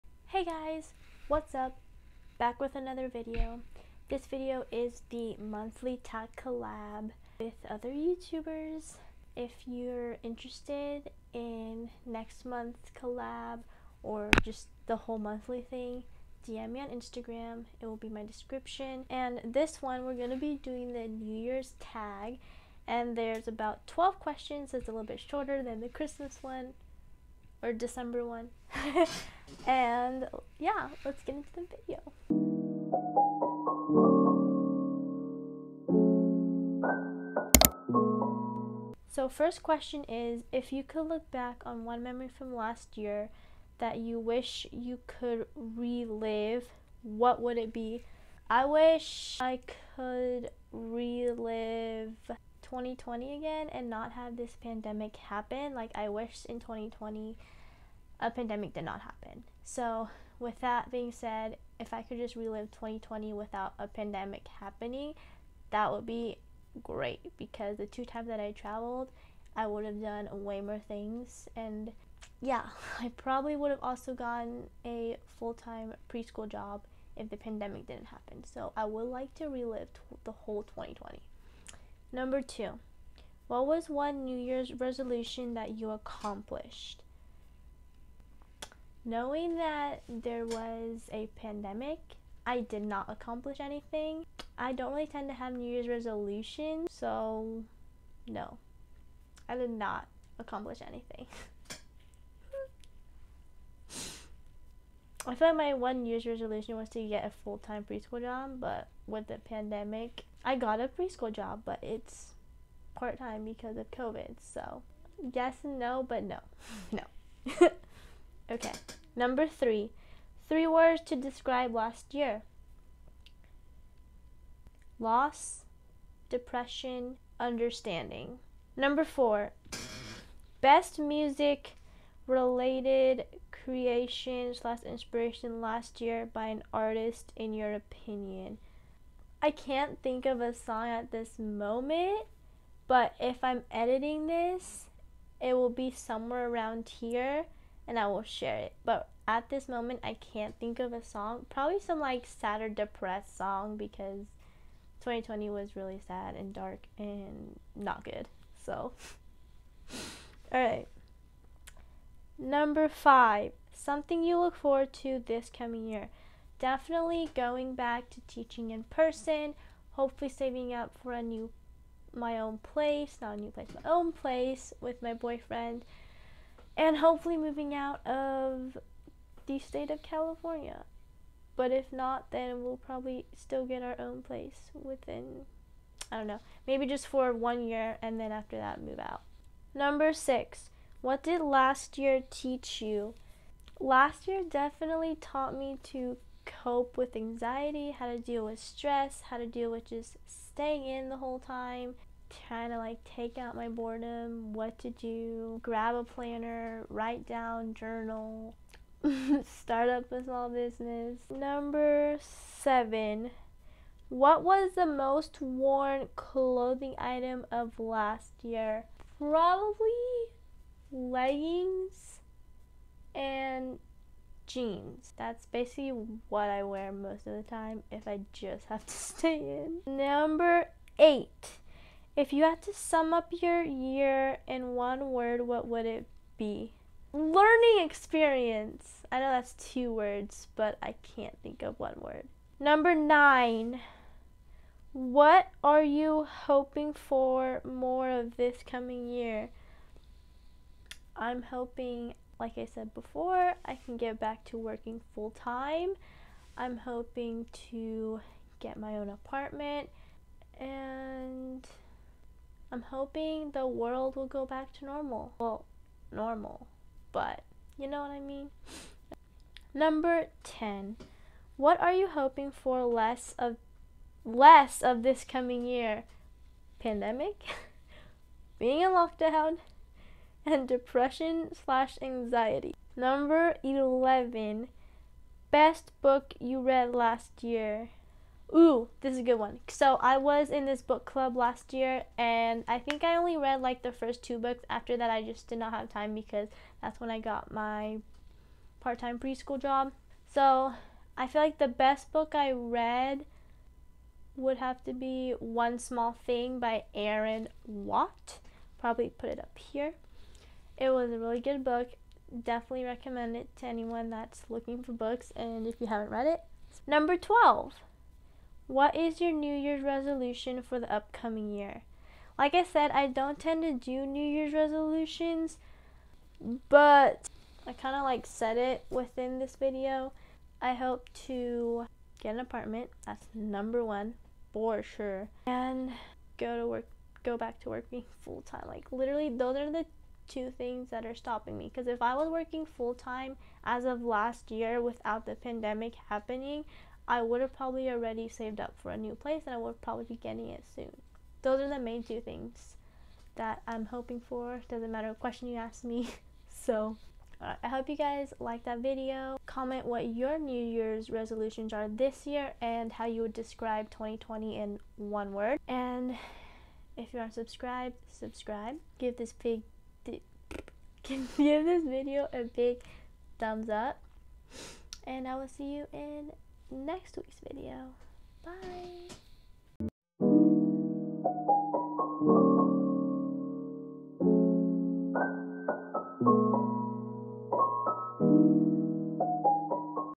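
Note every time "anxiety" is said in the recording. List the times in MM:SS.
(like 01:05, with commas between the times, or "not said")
03:17, 04:42.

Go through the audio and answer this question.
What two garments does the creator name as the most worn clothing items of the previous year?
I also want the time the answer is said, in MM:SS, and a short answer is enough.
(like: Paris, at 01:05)
Leggings and jeans, at 03:40.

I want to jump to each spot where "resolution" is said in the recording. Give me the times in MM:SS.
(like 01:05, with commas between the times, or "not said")
01:24, 01:35, 01:46, 05:19, 05:24, 06:01.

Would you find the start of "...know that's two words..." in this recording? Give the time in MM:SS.
03:59.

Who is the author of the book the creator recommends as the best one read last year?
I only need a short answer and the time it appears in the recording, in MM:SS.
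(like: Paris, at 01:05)
Erin Watt, at 05:06.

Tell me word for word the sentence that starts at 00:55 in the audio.
Like, I wish in 2020 a pandemic did not happen.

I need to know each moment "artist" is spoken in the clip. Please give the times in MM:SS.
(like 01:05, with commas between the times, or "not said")
02:16.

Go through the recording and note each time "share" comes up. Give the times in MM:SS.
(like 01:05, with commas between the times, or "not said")
02:28.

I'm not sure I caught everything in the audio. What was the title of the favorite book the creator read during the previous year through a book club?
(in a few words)
One Small Thing.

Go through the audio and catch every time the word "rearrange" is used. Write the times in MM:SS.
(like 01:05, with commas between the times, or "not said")
not said.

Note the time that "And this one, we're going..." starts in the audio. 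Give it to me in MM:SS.
00:19.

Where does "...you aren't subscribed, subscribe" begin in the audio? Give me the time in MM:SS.
06:07.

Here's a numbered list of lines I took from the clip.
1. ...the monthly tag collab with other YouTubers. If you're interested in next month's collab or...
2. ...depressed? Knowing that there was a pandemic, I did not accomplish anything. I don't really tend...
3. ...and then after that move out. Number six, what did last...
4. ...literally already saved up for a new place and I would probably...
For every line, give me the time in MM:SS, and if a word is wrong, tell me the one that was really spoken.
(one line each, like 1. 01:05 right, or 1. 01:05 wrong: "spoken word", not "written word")
1. 00:05 right
2. 01:25 wrong: "accomplished", not "depressed"
3. 03:08 right
4. 05:47 wrong: "probably", not "literally".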